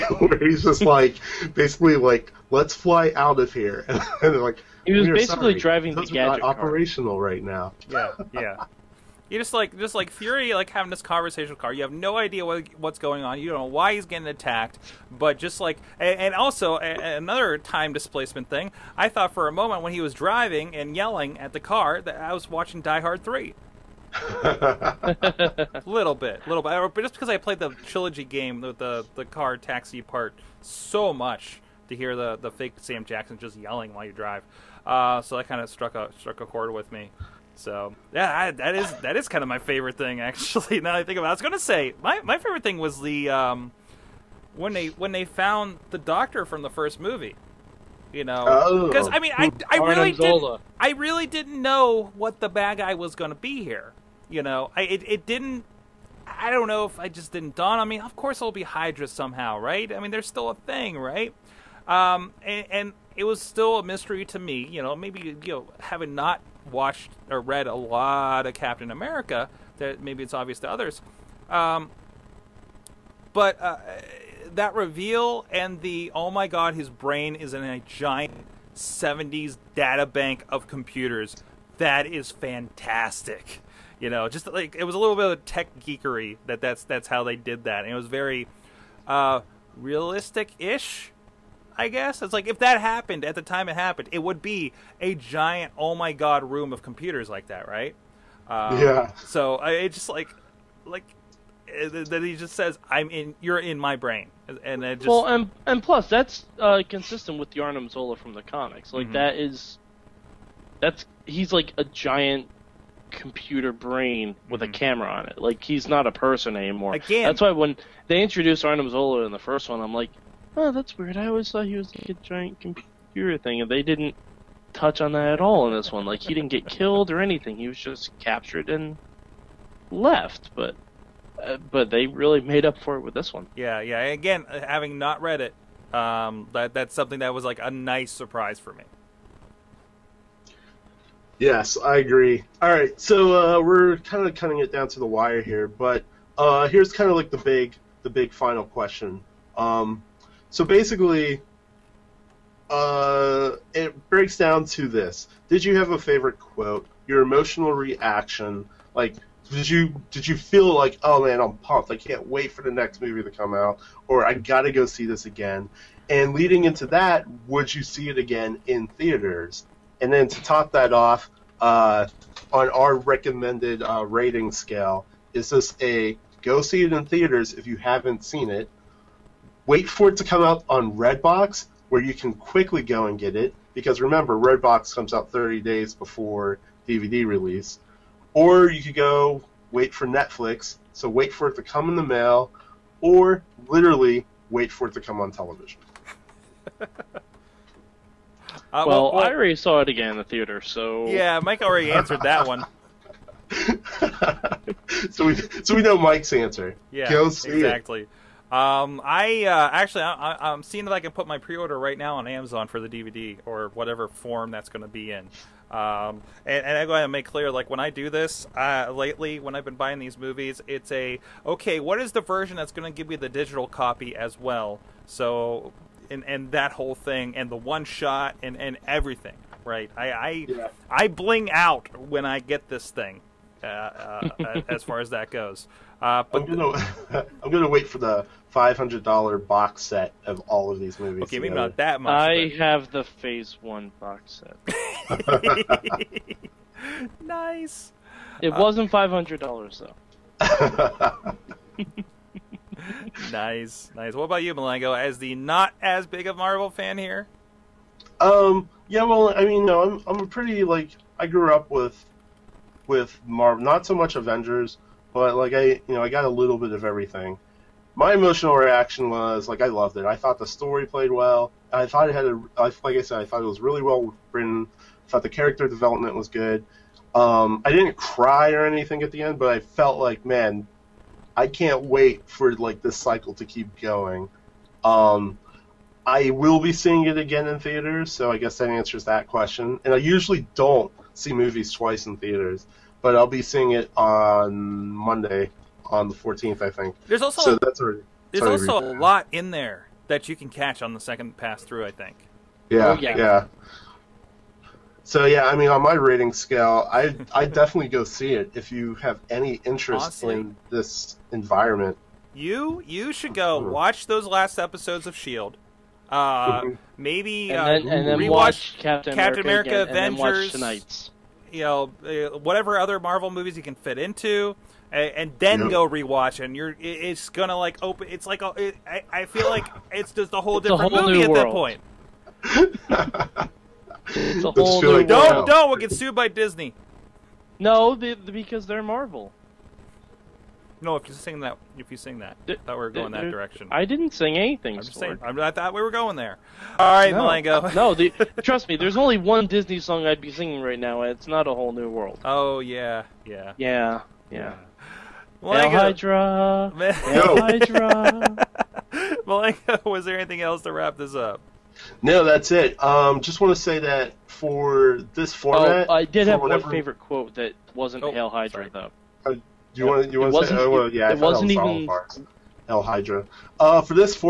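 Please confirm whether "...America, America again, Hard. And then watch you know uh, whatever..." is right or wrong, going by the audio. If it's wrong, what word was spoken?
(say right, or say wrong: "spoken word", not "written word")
wrong: "Avengers", not "Hard".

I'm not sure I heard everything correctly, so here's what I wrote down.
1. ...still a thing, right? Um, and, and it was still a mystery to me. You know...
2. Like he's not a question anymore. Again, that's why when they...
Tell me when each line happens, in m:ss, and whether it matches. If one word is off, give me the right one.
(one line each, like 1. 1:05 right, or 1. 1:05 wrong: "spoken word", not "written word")
1. 1:00 right
2. 1:55 wrong: "person", not "question".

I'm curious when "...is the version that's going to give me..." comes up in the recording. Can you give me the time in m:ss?
3:41.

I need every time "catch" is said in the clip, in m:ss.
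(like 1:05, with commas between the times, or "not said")
5:00.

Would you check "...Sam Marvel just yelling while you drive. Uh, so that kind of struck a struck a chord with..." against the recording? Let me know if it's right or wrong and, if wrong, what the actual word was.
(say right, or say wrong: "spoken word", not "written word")
wrong: "Jackson", not "Marvel".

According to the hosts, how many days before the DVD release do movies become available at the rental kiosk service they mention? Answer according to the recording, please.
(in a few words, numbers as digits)
30.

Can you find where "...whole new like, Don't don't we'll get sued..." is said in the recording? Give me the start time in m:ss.
5:34.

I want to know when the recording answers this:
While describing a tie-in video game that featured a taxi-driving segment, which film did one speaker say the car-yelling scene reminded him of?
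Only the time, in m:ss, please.
0:22.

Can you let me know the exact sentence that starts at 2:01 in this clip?
I always thought he was like a giant computer thing, and they didn't touch on that at all in this one.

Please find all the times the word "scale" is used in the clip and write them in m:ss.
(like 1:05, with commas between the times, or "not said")
2:54, 5:06.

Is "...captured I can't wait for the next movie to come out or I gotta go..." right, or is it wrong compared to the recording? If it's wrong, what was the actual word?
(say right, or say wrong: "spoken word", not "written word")
wrong: "pumped", not "captured".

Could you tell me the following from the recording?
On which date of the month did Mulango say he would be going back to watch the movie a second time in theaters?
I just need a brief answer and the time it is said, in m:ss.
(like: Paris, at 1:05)
the 14th, at 4:56.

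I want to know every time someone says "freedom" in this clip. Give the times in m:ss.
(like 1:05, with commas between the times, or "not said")
not said.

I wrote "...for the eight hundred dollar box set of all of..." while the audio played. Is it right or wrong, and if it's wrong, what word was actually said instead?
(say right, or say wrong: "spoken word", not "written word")
wrong: "five", not "eight".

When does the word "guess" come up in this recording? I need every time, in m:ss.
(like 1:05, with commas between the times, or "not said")
1:31, 4:48.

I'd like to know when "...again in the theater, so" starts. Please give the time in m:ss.
3:19.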